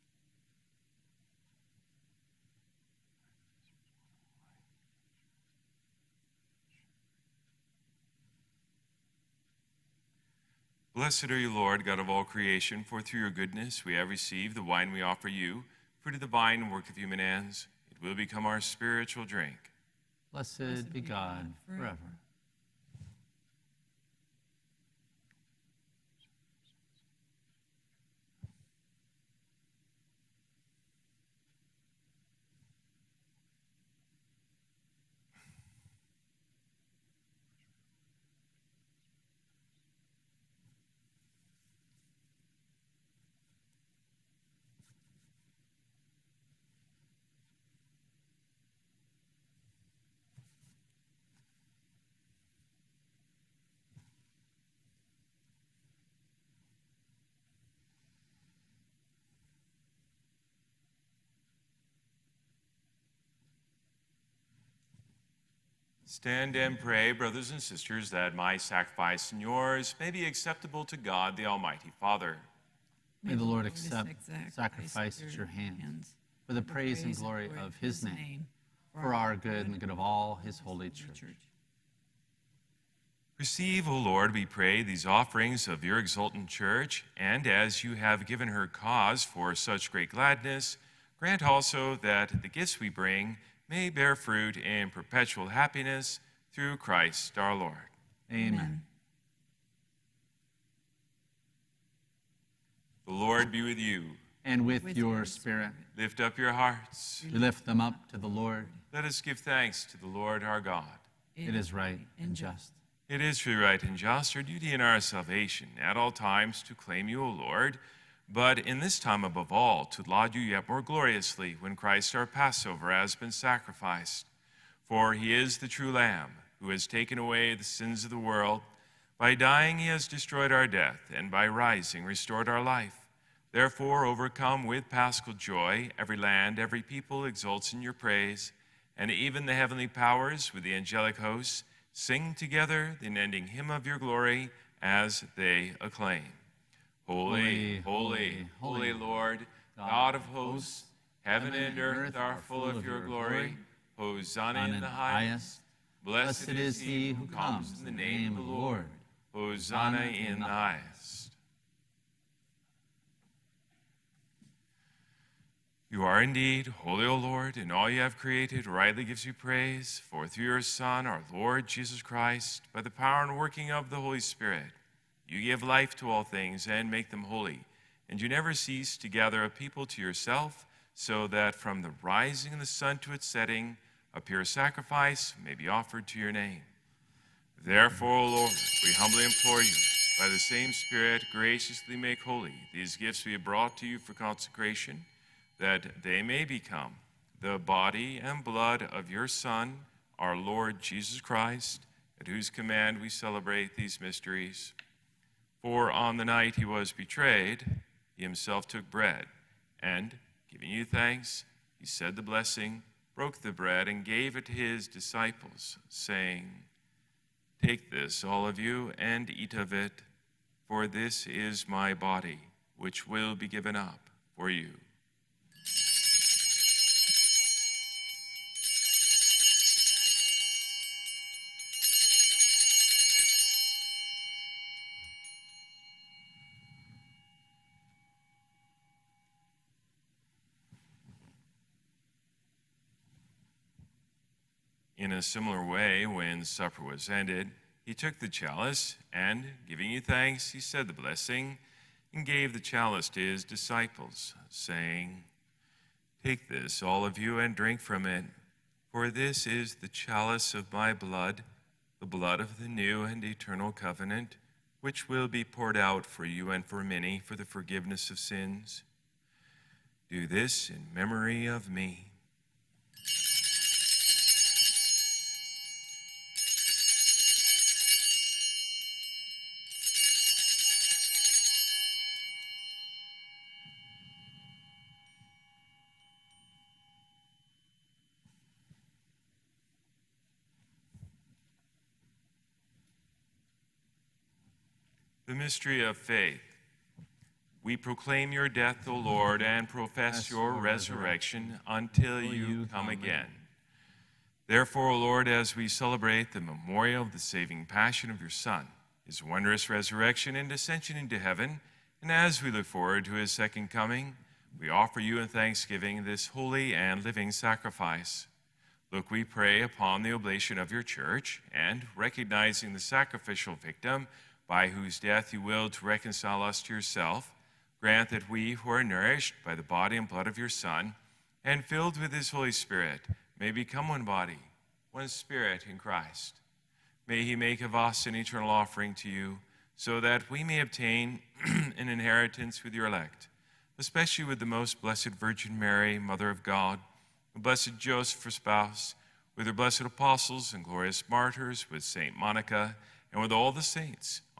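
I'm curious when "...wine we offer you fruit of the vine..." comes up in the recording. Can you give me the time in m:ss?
0:14.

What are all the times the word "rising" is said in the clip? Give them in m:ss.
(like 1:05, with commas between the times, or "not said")
2:11, 3:02.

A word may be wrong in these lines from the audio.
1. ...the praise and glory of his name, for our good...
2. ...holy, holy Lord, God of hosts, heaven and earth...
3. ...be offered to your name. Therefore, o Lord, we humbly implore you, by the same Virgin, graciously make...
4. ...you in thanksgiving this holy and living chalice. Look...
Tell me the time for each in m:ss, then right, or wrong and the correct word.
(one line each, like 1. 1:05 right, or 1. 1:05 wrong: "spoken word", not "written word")
1. 1:16 right
2. 2:27 right
3. 3:05 wrong: "Spirit", not "Virgin"
4. 5:14 wrong: "sacrifice", not "chalice".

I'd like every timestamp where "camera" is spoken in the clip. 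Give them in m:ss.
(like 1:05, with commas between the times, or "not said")
not said.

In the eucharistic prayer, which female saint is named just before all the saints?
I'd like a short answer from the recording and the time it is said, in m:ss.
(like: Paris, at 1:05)
Saint Monica, at 5:51.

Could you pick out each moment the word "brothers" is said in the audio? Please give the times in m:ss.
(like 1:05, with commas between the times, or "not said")
1:07.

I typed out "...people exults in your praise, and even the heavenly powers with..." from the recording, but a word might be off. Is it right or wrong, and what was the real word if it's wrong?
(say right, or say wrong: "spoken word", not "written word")
right.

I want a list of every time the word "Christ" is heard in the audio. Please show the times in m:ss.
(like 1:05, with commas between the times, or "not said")
1:36, 2:01, 2:51, 3:21, 5:35.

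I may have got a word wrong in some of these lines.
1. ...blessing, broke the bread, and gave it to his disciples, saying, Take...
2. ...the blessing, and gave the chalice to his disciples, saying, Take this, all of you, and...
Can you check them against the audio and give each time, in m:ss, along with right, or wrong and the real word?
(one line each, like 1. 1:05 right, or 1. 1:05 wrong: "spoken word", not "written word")
1. 3:32 right
2. 4:10 right.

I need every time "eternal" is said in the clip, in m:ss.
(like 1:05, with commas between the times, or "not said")
4:23, 5:38.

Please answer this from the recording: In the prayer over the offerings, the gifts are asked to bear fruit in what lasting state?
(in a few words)
perpetual happiness.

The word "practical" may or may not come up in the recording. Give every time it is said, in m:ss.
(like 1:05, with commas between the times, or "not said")
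not said.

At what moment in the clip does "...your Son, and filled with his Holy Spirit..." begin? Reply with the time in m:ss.
5:30.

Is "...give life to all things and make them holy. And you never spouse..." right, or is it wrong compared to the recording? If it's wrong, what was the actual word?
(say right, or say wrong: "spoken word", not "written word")
wrong: "cease", not "spouse".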